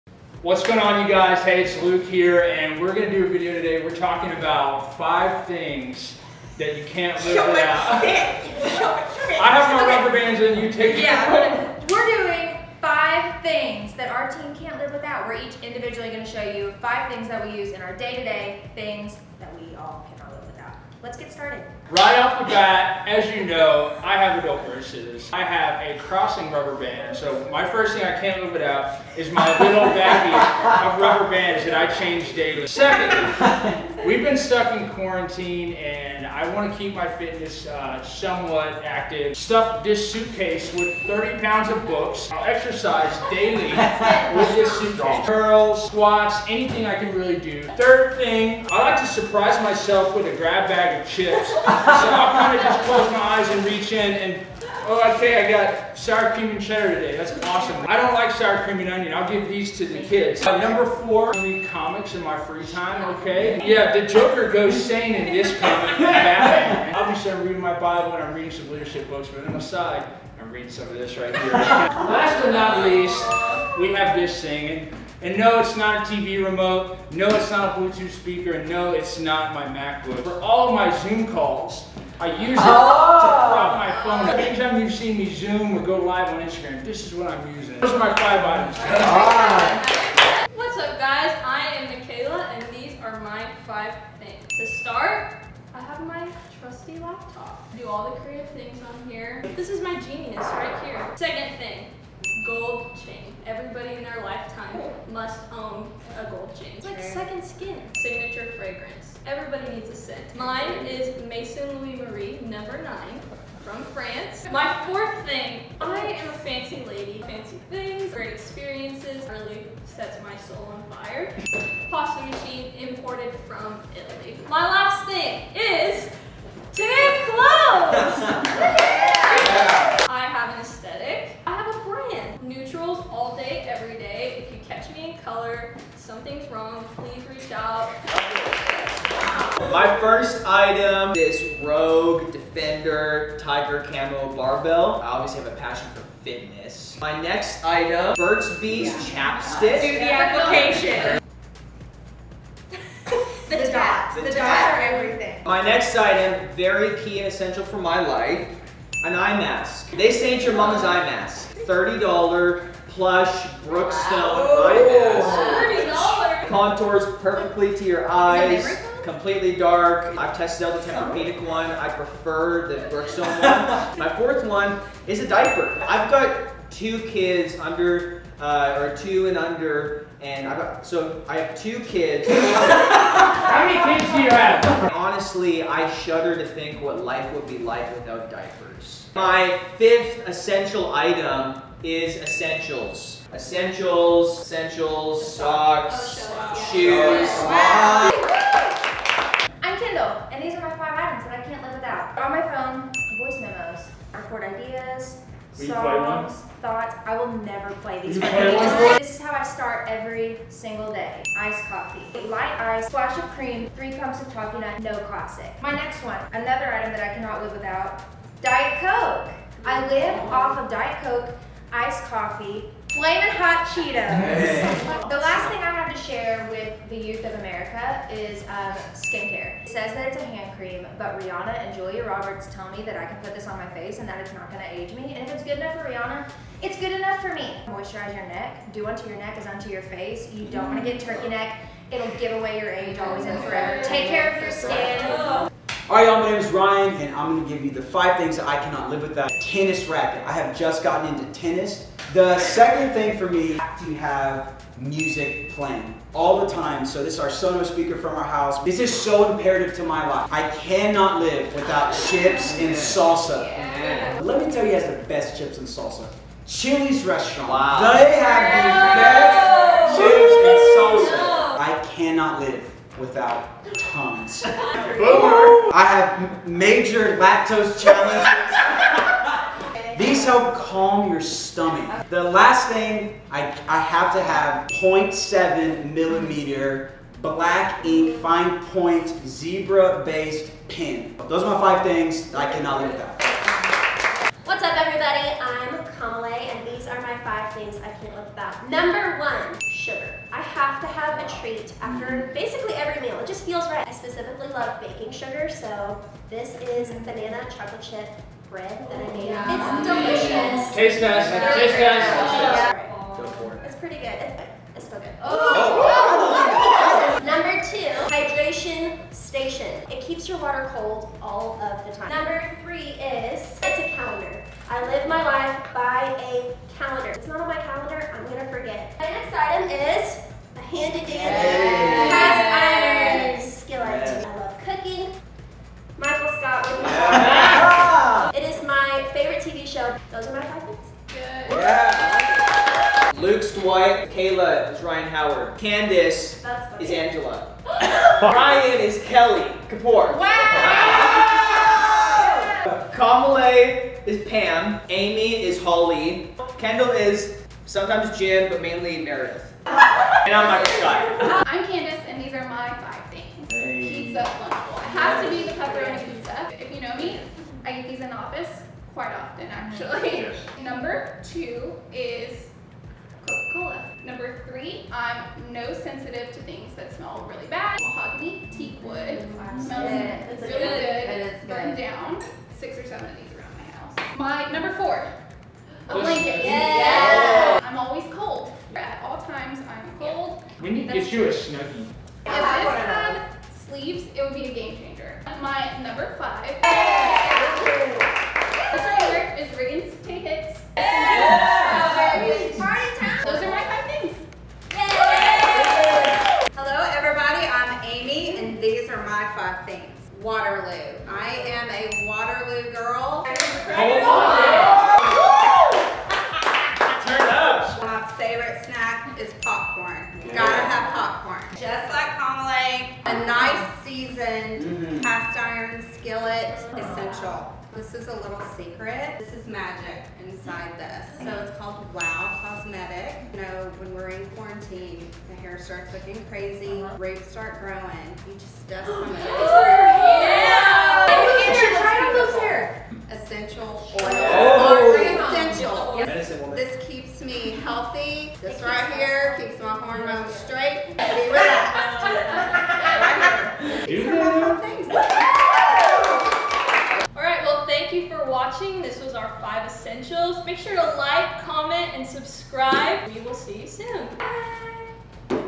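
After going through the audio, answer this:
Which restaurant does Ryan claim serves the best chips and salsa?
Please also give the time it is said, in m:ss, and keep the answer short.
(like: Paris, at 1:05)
Chili's, at 4:26.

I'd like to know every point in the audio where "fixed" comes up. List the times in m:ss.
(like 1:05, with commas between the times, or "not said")
not said.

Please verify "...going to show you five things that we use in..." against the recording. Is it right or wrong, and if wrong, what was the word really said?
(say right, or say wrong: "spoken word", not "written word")
right.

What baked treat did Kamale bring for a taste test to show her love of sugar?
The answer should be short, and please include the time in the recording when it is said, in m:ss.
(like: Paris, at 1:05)
banana chocolate chip bread, at 5:07.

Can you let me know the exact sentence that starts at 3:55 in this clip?
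And if it's good enough for Rihanna, it's good enough for me.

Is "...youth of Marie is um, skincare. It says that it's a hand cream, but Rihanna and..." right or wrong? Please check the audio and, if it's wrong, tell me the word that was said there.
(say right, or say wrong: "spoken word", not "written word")
wrong: "America", not "Marie".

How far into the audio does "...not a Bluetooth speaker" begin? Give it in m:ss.
1:17.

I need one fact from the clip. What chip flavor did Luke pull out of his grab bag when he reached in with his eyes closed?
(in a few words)
sour cream and cheddar.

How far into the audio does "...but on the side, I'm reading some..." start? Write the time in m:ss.
1:09.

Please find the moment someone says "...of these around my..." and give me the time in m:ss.
6:23.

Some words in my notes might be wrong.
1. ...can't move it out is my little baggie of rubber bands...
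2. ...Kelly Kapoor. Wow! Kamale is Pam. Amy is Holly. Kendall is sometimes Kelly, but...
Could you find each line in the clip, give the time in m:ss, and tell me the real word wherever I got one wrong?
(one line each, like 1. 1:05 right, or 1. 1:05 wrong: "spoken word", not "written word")
1. 0:28 right
2. 5:49 wrong: "Jim", not "Kelly".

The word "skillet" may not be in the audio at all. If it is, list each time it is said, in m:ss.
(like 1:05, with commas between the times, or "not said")
5:33, 7:05.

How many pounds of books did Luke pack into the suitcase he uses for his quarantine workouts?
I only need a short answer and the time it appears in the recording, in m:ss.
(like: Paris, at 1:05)
30, at 0:41.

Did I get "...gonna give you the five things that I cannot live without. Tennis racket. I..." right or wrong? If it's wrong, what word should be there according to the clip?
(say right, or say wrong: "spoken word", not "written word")
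right.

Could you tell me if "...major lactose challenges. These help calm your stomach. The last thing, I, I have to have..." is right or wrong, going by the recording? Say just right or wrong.
right.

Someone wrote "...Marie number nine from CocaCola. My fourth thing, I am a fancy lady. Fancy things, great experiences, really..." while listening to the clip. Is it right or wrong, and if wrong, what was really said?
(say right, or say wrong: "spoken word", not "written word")
wrong: "France", not "CocaCola".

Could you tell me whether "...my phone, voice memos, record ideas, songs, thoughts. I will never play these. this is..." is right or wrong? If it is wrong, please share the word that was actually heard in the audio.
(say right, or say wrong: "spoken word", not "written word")
right.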